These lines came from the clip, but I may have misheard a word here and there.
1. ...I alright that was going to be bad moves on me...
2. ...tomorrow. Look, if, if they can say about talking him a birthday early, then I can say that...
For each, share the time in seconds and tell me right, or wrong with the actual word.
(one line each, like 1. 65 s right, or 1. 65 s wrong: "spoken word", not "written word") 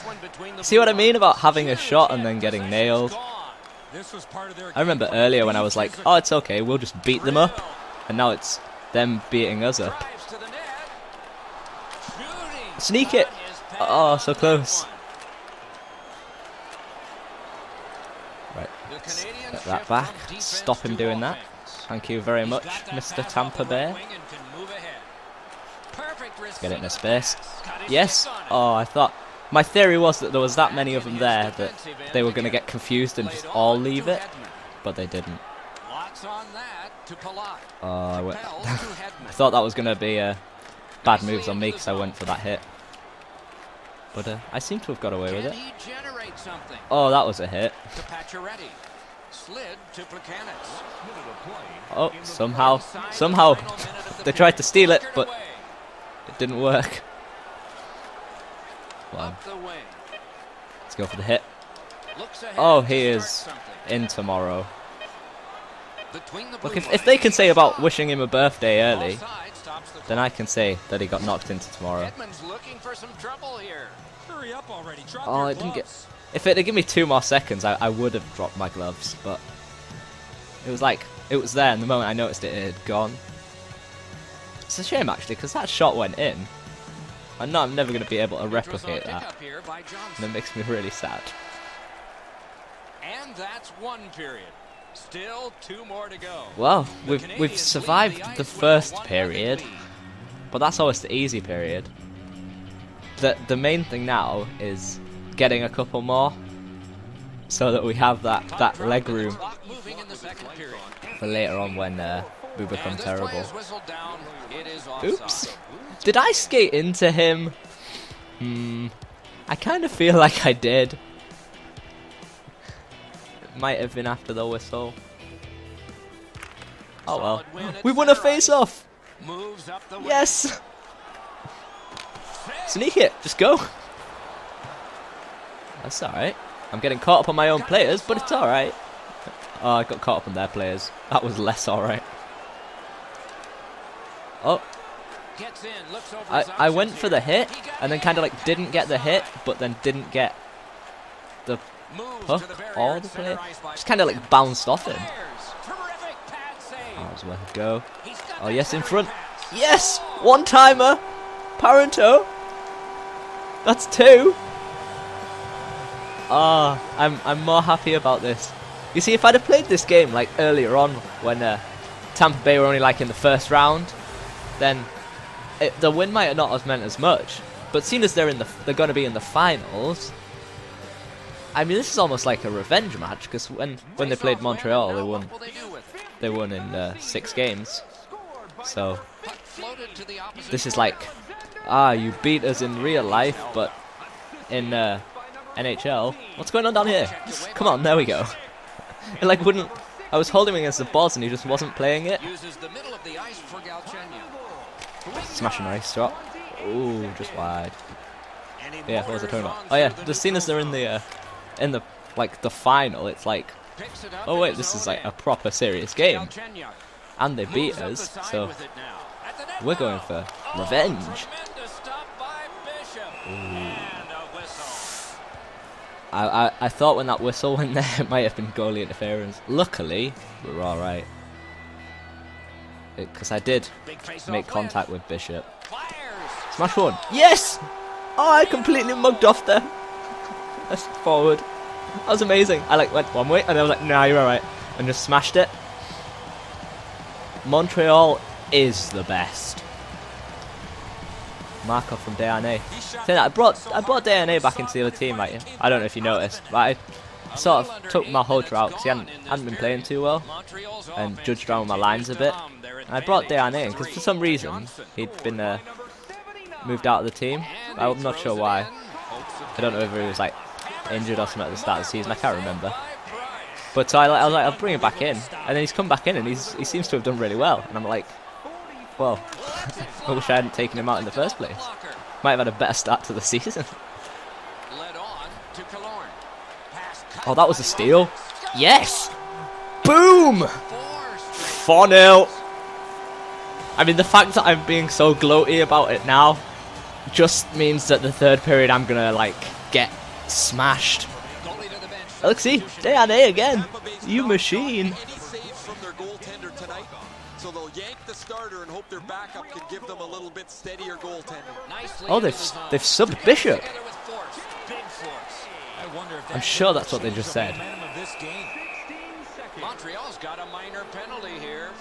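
1. 39 s wrong: "thought", not "alright"
2. 64 s wrong: "wishing", not "talking".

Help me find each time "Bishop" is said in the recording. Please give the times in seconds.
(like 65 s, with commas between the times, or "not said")
235 s, 313 s.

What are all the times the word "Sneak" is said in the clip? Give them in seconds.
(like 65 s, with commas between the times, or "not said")
12 s, 132 s.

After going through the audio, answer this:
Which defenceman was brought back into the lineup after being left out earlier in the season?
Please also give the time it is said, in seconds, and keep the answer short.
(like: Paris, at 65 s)
Markov, at 251 s.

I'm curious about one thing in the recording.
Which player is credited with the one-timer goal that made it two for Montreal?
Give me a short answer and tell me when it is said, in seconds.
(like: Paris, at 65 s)
Parenteau, at 161 s.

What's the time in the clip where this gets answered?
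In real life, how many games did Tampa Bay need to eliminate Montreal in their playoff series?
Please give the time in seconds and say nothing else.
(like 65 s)
186 s.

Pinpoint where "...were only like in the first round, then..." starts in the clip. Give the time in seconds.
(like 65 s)
172 s.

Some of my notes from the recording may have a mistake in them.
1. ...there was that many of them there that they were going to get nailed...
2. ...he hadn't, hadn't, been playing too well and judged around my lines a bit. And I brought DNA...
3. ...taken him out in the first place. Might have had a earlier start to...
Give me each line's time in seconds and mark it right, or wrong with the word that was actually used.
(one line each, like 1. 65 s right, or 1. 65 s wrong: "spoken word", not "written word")
1. 30 s wrong: "confused", not "nailed"
2. 258 s right
3. 280 s wrong: "better", not "earlier".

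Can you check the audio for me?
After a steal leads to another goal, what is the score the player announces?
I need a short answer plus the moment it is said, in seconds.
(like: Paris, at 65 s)
4 0, at 290 s.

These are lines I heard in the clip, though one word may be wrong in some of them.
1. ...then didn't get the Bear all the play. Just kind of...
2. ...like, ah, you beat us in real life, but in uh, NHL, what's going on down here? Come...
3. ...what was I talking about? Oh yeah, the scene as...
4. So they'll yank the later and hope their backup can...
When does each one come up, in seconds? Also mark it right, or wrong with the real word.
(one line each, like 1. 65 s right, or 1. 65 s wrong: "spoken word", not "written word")
1. 149 s wrong: "Hook", not "Bear"
2. 190 s right
3. 209 s right
4. 307 s wrong: "starter", not "later".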